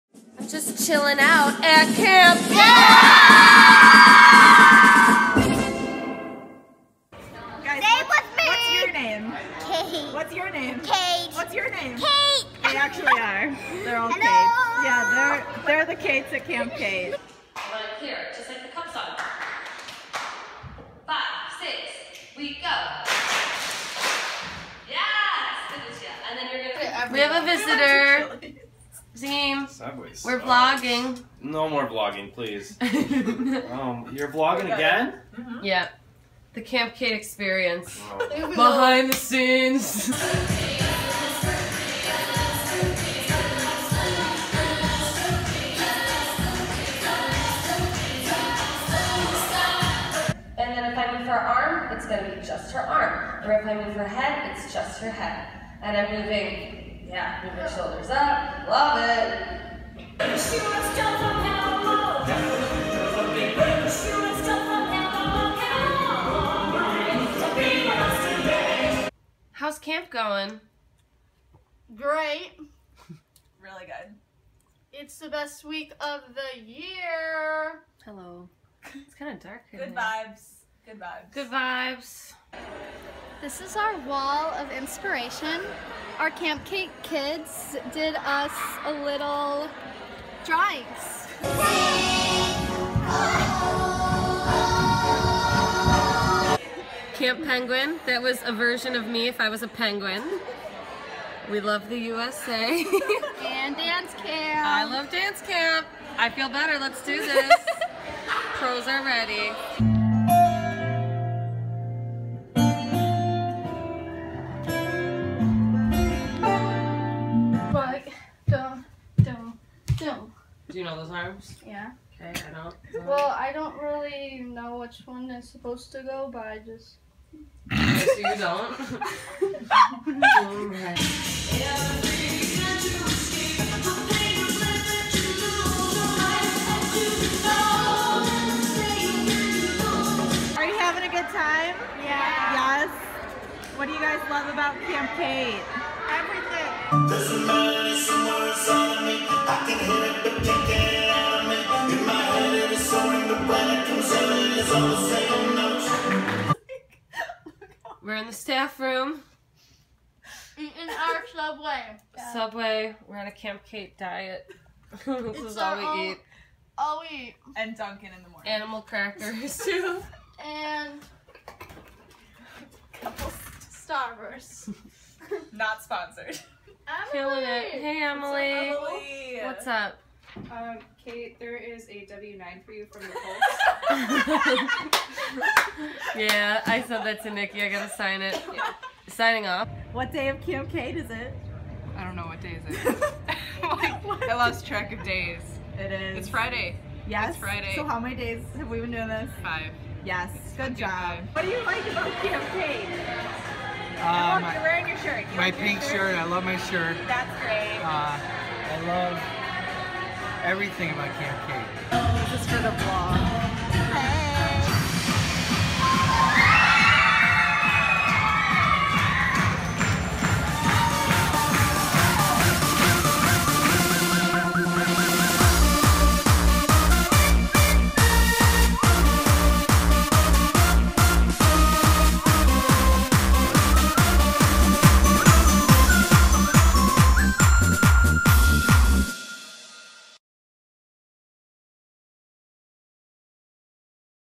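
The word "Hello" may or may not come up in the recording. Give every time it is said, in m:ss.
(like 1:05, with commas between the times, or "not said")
0:14, 1:18.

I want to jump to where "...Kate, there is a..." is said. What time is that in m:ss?
3:01.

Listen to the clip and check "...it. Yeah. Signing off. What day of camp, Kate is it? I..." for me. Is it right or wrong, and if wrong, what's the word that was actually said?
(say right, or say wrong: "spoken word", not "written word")
right.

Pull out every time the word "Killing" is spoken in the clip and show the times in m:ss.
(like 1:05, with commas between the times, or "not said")
2:57.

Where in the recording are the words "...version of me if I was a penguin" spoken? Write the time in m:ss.
1:38.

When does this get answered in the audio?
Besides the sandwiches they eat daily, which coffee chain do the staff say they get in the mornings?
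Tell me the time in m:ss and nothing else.
2:47.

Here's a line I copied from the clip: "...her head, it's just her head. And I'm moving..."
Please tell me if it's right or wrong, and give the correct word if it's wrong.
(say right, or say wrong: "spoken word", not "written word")
right.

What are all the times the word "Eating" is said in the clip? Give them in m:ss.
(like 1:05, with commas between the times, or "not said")
2:40.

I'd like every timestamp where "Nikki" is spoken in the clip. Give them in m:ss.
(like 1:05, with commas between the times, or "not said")
3:07.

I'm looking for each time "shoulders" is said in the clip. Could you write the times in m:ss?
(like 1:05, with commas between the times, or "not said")
0:57.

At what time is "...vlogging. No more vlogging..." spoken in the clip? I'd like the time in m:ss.
0:30.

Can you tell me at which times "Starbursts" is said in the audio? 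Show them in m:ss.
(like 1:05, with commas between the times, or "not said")
2:53.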